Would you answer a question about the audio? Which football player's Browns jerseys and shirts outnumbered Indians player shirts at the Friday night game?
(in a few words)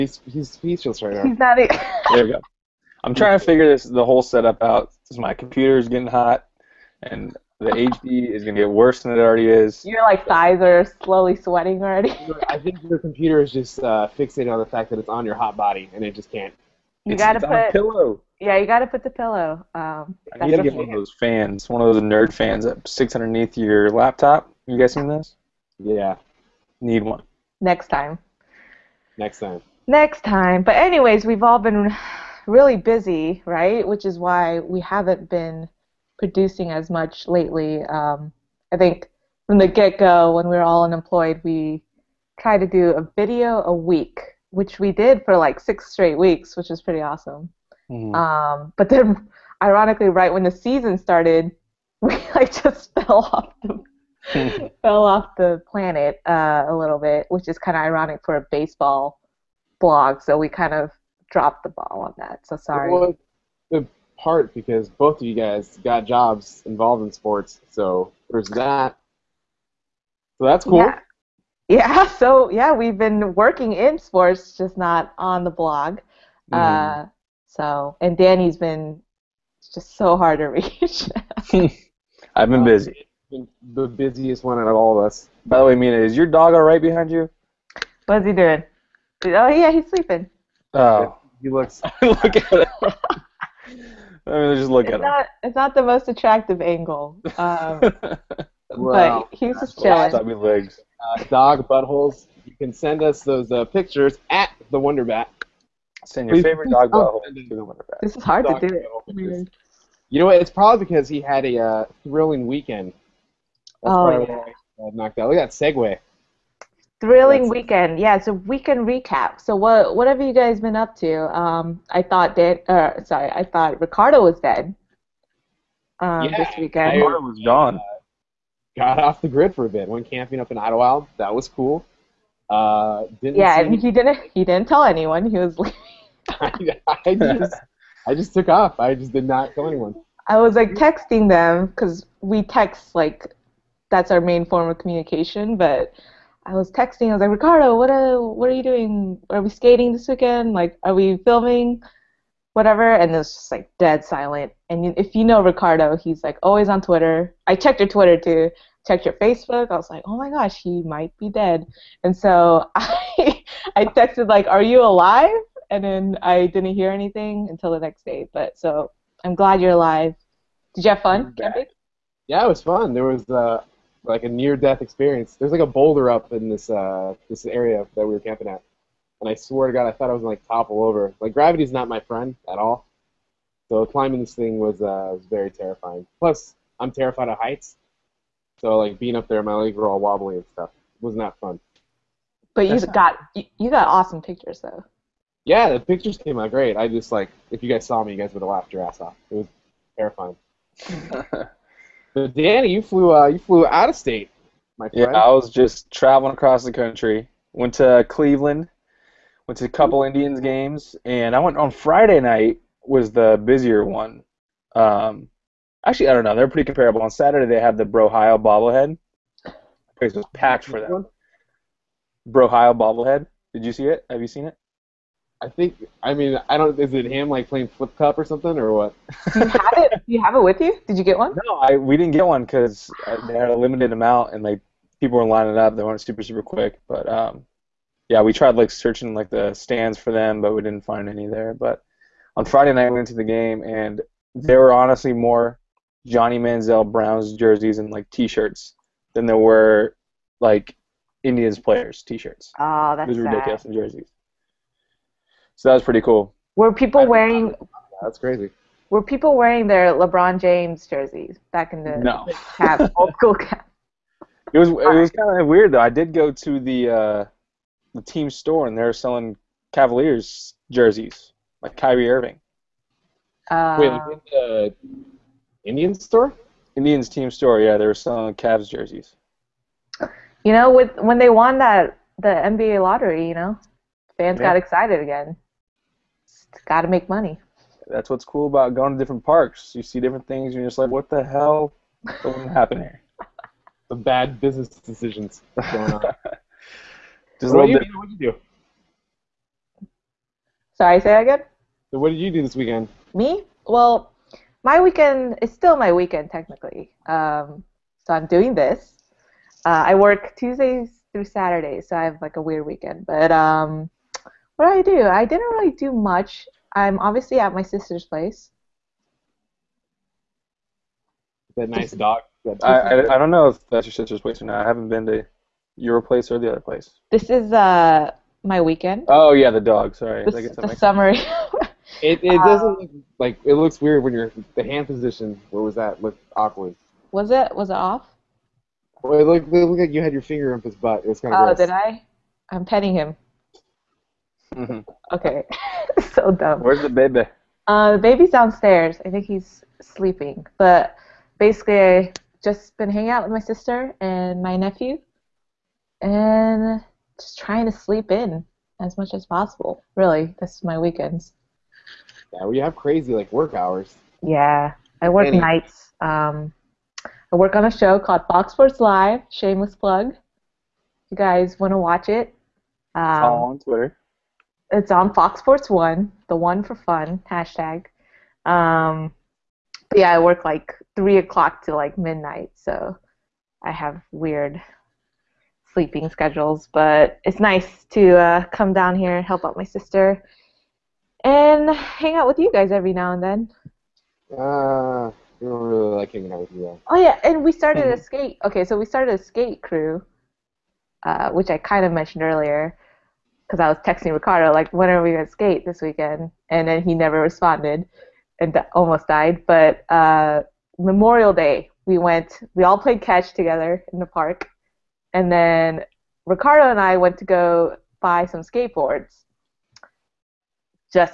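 Johnny Manziel.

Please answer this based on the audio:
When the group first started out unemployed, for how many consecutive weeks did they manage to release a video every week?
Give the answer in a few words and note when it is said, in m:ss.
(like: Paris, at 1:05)
6, at 0:45.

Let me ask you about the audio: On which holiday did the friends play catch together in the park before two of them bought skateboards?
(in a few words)
Memorial Day.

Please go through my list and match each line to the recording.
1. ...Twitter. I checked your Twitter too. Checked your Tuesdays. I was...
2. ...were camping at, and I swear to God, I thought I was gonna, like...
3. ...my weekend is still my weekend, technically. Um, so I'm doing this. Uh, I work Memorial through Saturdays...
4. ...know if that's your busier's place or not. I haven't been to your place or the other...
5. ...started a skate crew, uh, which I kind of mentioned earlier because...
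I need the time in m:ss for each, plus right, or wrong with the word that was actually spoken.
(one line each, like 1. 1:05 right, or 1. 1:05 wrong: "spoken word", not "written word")
1. 2:36 wrong: "Facebook", not "Tuesdays"
2. 2:58 right
3. 5:04 wrong: "Tuesdays", not "Memorial"
4. 5:23 wrong: "sister", not "busier"
5. 6:38 right.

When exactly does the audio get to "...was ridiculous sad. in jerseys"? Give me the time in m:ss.
4:13.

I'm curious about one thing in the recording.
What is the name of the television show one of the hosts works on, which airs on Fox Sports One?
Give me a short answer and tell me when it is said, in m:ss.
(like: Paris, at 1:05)
Fox Sports Live, at 6:08.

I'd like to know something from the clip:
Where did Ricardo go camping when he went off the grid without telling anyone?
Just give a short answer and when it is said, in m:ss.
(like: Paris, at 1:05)
Idyllwild, at 2:10.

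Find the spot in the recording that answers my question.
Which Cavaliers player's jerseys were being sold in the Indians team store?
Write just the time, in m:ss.
4:31.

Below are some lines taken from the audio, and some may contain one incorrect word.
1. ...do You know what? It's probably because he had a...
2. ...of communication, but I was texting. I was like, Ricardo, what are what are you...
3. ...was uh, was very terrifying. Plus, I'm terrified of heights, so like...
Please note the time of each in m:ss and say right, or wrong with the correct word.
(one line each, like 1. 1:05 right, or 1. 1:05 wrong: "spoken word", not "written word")
1. 1:48 right
2. 2:24 right
3. 3:04 right.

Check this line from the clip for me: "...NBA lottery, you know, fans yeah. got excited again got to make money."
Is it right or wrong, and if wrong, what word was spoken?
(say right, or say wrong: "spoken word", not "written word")
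right.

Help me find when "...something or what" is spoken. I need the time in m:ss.
3:48.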